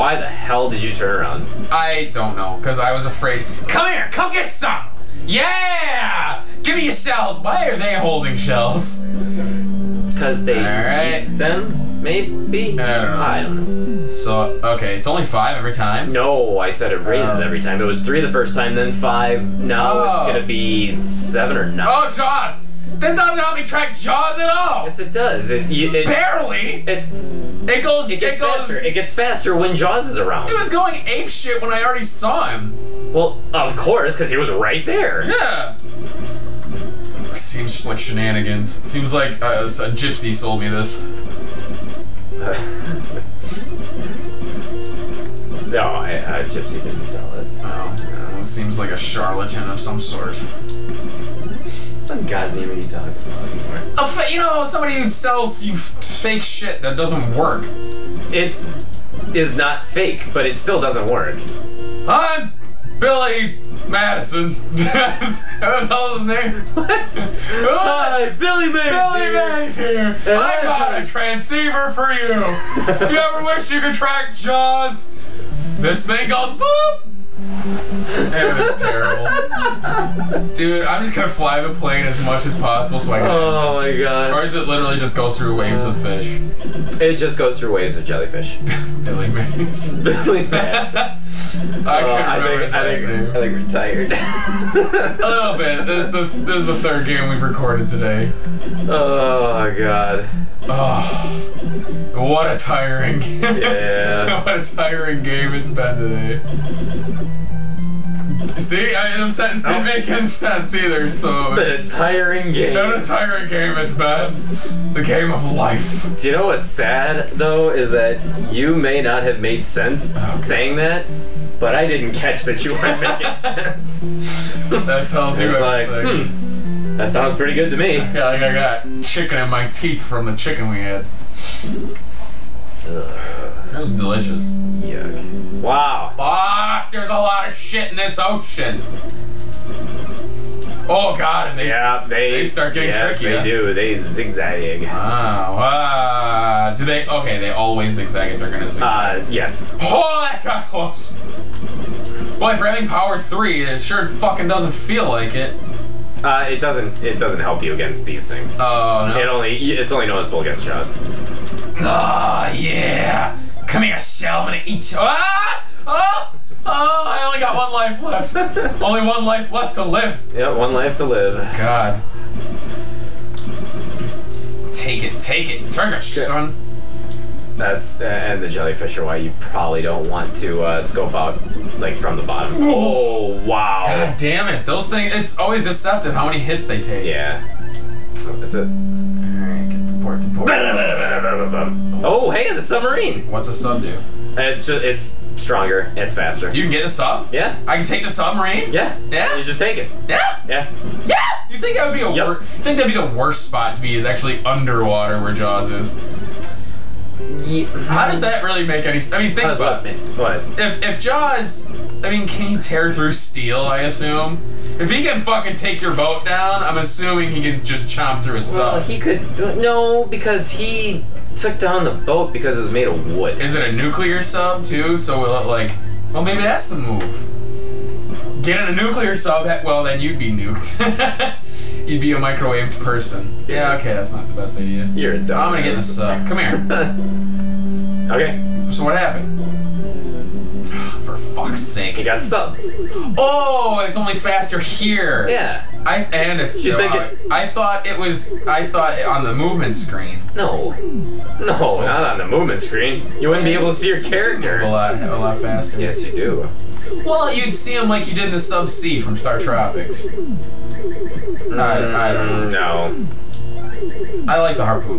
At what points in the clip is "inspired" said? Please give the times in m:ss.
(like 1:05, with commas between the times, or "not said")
not said.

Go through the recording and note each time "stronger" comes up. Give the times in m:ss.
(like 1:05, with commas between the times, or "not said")
3:15.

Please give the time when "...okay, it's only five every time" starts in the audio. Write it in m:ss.
0:14.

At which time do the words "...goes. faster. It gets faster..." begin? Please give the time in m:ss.
0:28.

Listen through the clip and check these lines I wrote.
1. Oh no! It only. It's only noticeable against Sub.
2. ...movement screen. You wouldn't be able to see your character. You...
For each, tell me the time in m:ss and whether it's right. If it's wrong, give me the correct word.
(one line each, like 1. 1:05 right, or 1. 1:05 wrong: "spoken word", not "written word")
1. 2:38 wrong: "Jaws", not "Sub"
2. 4:12 right.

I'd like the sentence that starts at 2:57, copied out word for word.
That's eh, and the jellyfish are why you probably don't want to uh, scope out like from the bottom.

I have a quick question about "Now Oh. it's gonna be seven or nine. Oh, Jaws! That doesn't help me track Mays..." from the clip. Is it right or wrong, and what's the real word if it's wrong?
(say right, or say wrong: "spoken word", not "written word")
wrong: "Jaws", not "Mays".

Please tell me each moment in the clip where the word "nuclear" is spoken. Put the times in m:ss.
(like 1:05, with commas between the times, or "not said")
3:43, 3:48.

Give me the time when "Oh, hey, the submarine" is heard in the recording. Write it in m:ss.
3:12.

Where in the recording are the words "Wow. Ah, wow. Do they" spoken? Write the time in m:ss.
2:24.